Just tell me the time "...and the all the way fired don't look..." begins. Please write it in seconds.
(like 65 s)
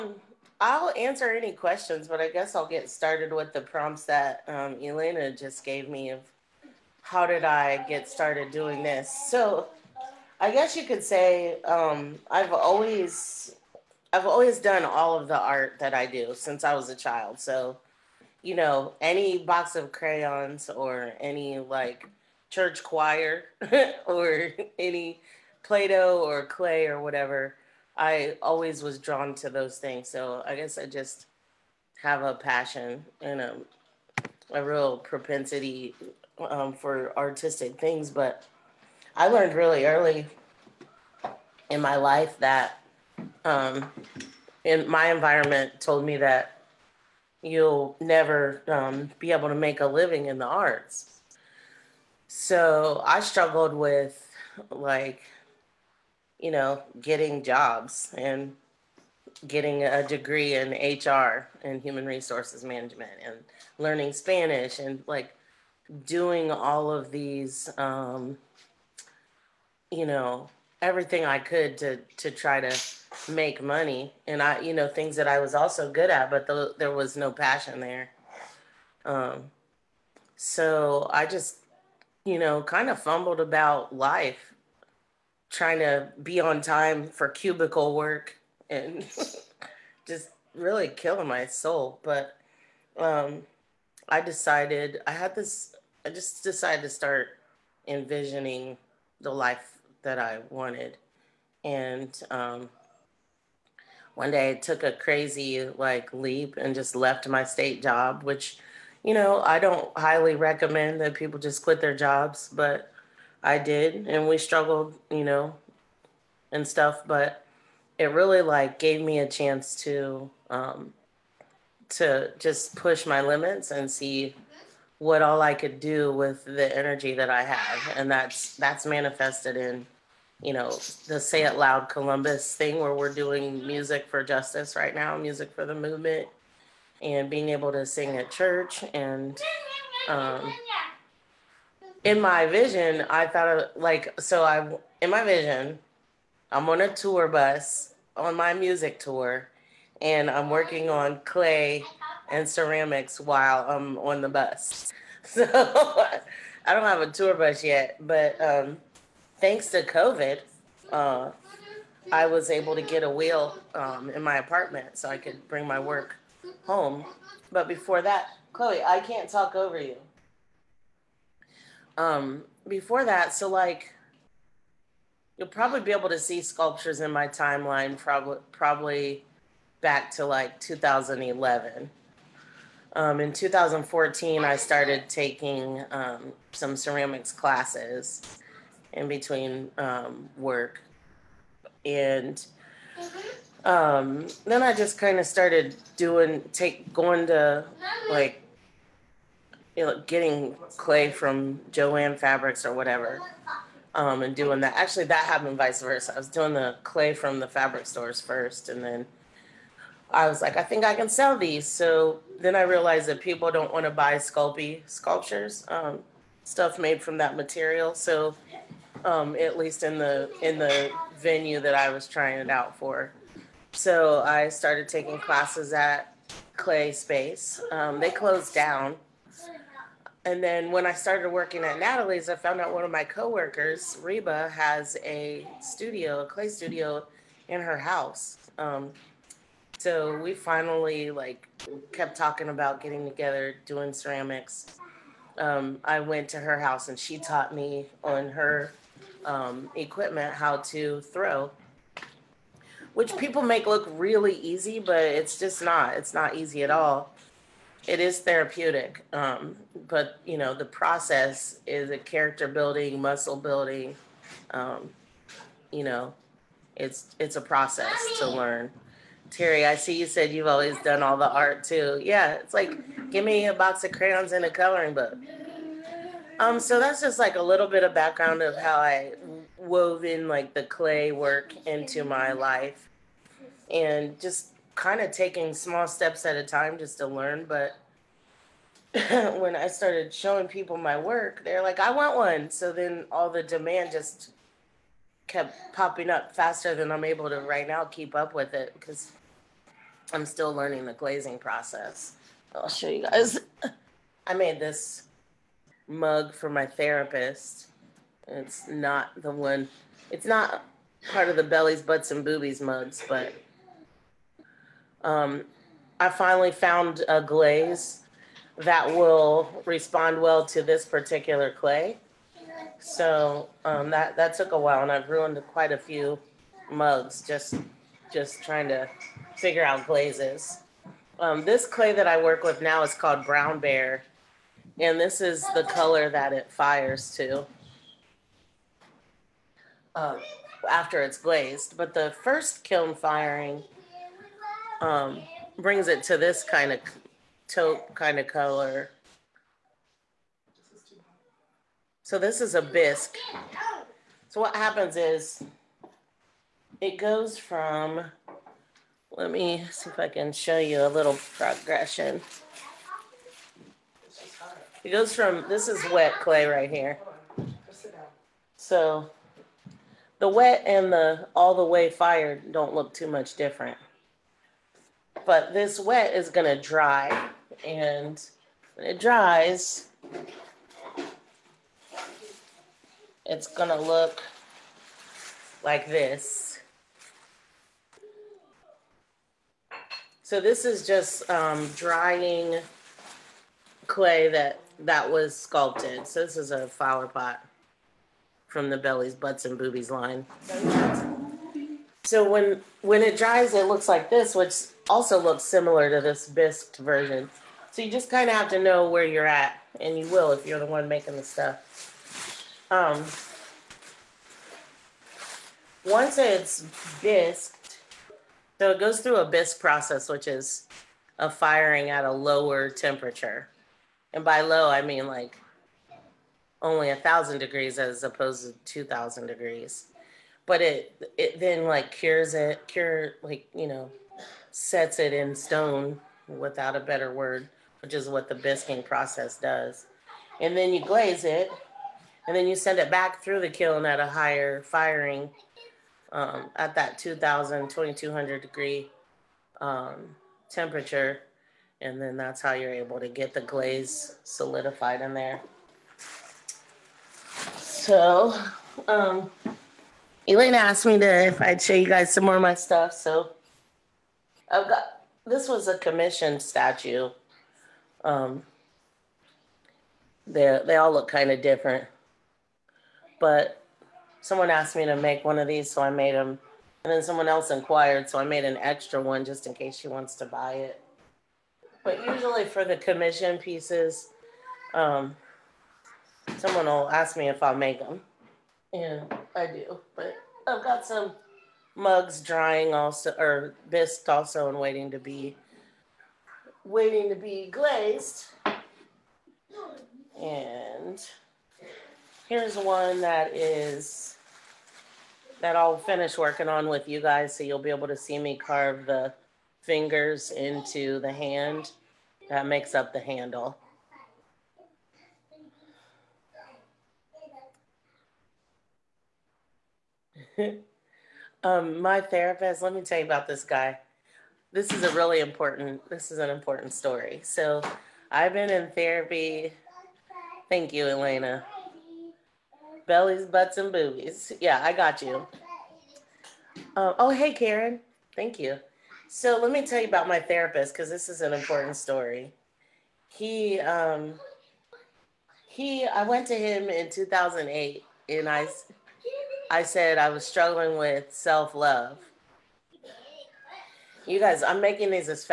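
370 s.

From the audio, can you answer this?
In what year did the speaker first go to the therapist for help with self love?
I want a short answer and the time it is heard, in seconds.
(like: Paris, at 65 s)
2008, at 546 s.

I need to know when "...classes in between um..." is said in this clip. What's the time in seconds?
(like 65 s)
187 s.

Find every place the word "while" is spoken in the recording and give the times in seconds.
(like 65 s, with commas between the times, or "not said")
153 s, 324 s.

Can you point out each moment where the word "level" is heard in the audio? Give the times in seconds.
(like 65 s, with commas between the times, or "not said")
not said.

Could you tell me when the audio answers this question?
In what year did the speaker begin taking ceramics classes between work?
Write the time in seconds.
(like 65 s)
183 s.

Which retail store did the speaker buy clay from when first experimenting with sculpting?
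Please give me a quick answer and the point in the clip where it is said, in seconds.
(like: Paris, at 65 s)
Jo-Ann Fabrics, at 201 s.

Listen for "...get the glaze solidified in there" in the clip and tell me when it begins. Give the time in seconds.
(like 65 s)
453 s.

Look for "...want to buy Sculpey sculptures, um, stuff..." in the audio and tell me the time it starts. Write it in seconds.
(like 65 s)
213 s.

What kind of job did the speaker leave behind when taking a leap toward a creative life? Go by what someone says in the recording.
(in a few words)
State job.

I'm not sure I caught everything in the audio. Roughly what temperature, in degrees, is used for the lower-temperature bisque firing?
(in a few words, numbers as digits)
1000.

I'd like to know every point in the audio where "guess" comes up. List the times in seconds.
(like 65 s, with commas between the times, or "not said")
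2 s, 10 s, 30 s.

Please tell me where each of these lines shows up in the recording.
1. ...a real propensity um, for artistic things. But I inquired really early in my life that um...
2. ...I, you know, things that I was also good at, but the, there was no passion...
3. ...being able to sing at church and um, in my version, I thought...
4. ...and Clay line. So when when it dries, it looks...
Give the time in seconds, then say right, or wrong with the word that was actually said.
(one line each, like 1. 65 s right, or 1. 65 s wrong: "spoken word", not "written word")
1. 34 s wrong: "learned", not "inquired"
2. 74 s right
3. 137 s wrong: "vision", not "version"
4. 399 s wrong: "Boobies", not "Clay".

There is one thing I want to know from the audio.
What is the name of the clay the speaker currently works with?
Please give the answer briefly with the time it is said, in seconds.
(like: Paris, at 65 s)
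Brown Bear, at 333 s.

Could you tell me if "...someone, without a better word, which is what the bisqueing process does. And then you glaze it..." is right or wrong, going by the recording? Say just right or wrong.
wrong.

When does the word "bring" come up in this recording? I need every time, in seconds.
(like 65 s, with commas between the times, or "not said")
165 s, 345 s.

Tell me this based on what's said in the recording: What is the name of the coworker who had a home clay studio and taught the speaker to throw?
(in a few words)
Reba.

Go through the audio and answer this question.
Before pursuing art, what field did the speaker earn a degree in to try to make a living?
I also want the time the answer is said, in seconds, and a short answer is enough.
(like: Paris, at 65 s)
Human resources management, at 61 s.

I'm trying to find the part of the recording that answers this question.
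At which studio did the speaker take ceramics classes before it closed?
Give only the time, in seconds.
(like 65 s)
226 s.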